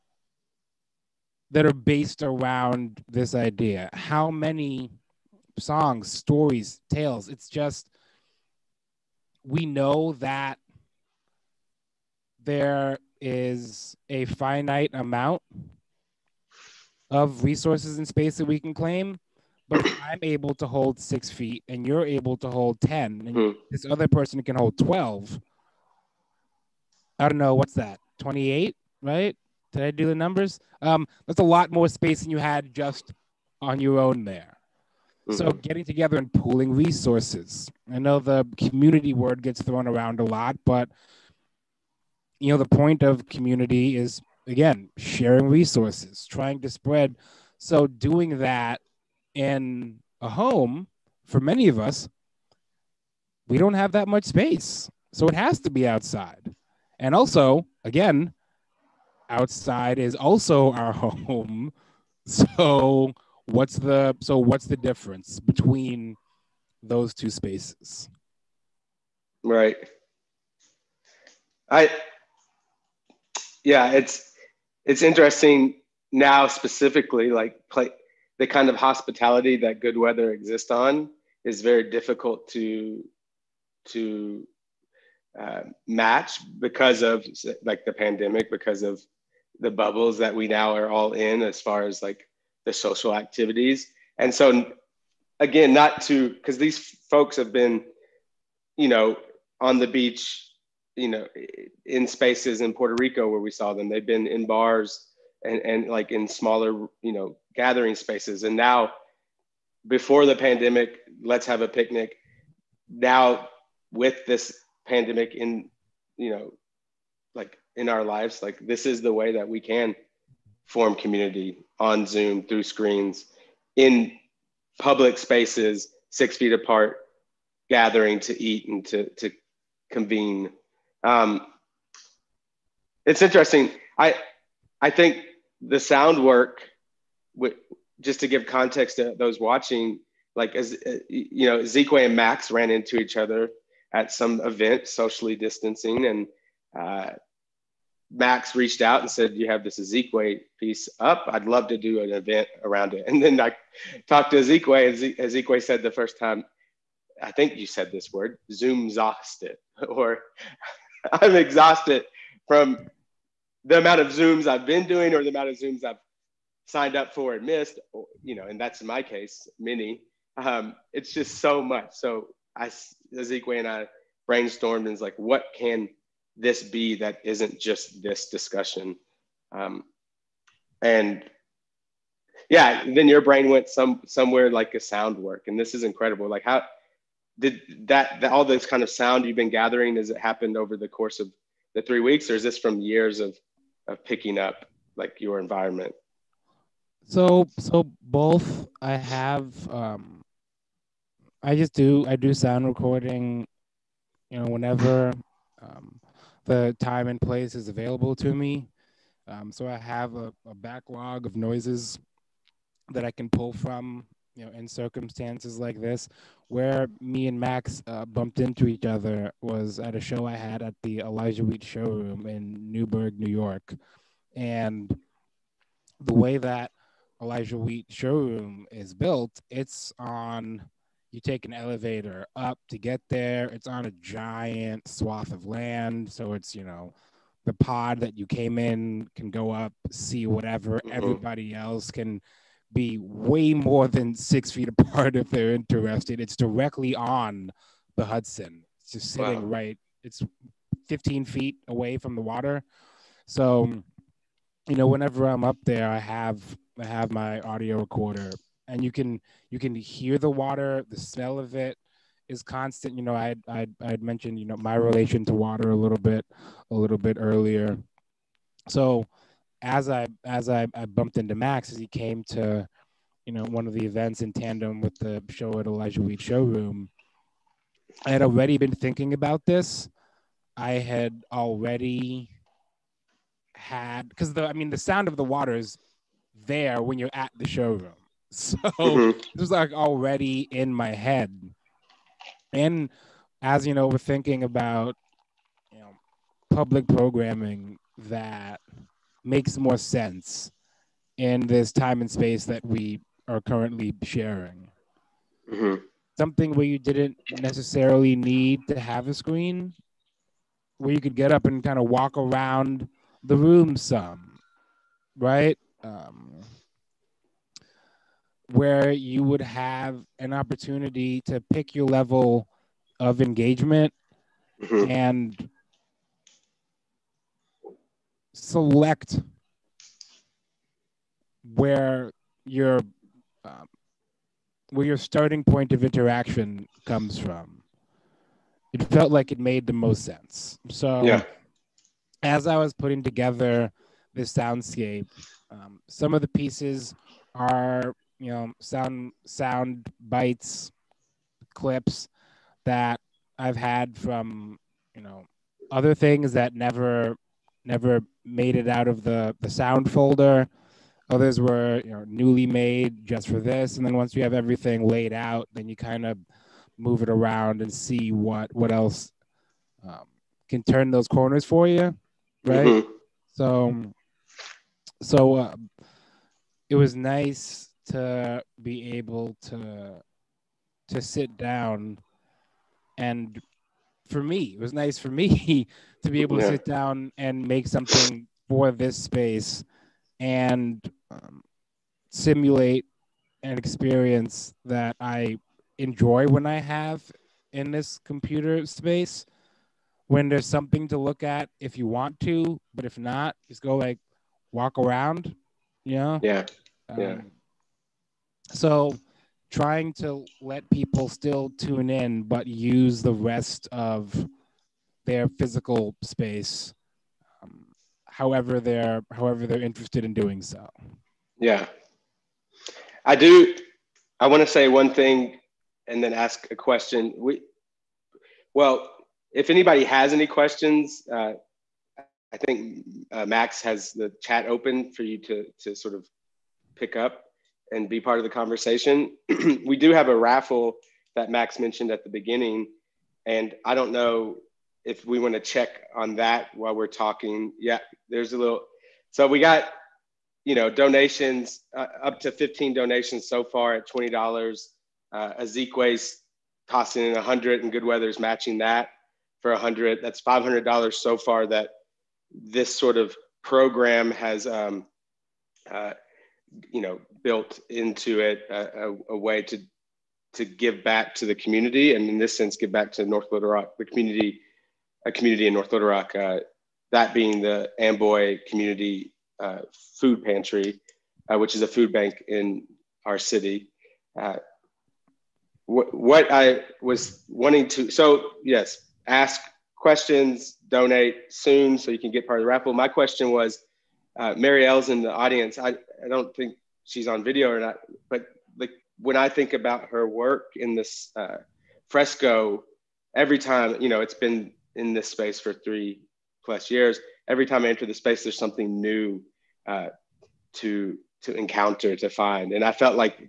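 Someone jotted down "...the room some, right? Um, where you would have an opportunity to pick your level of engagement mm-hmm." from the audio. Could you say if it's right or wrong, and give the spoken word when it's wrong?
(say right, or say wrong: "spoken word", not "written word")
right.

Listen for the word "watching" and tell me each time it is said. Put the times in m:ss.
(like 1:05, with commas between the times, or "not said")
2:19.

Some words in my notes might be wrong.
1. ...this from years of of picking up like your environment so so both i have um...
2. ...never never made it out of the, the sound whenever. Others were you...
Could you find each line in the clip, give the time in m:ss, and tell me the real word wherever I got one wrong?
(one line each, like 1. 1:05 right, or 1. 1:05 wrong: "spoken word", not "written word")
1. 3:12 right
2. 5:56 wrong: "folder", not "whenever".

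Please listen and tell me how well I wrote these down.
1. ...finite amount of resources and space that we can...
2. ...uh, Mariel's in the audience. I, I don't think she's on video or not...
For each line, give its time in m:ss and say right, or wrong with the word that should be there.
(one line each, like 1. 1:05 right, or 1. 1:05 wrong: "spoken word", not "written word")
1. 0:14 right
2. 8:14 right.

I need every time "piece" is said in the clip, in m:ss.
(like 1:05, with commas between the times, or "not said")
2:30, 5:46.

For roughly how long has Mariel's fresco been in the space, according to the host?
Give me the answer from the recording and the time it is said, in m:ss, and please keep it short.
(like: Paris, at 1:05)
3 plus years, at 8:25.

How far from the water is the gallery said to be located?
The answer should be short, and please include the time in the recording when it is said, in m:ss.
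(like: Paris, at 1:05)
15 feet, at 4:10.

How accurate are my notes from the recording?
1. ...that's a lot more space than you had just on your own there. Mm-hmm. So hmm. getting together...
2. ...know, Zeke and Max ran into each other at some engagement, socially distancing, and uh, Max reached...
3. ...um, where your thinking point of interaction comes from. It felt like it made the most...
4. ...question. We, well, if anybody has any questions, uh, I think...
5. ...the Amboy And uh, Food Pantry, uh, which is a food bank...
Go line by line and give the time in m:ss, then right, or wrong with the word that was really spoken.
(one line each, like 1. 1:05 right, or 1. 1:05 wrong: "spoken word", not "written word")
1. 0:31 right
2. 2:21 wrong: "event", not "engagement"
3. 5:33 wrong: "starting", not "thinking"
4. 7:06 right
5. 7:57 wrong: "Community", not "And".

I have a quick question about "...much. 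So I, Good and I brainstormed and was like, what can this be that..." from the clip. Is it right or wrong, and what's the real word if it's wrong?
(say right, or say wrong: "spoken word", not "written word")
wrong: "Azikiwe", not "Good".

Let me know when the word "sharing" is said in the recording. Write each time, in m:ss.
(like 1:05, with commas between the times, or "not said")
0:44, 5:04.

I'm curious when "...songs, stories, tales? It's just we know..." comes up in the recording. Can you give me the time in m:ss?
0:05.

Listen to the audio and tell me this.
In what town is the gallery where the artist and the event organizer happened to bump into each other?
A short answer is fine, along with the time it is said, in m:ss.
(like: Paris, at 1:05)
Newburgh, New York, at 3:42.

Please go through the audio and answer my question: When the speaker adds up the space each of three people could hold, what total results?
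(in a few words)
28.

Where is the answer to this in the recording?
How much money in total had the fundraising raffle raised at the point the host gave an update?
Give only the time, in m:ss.
7:40.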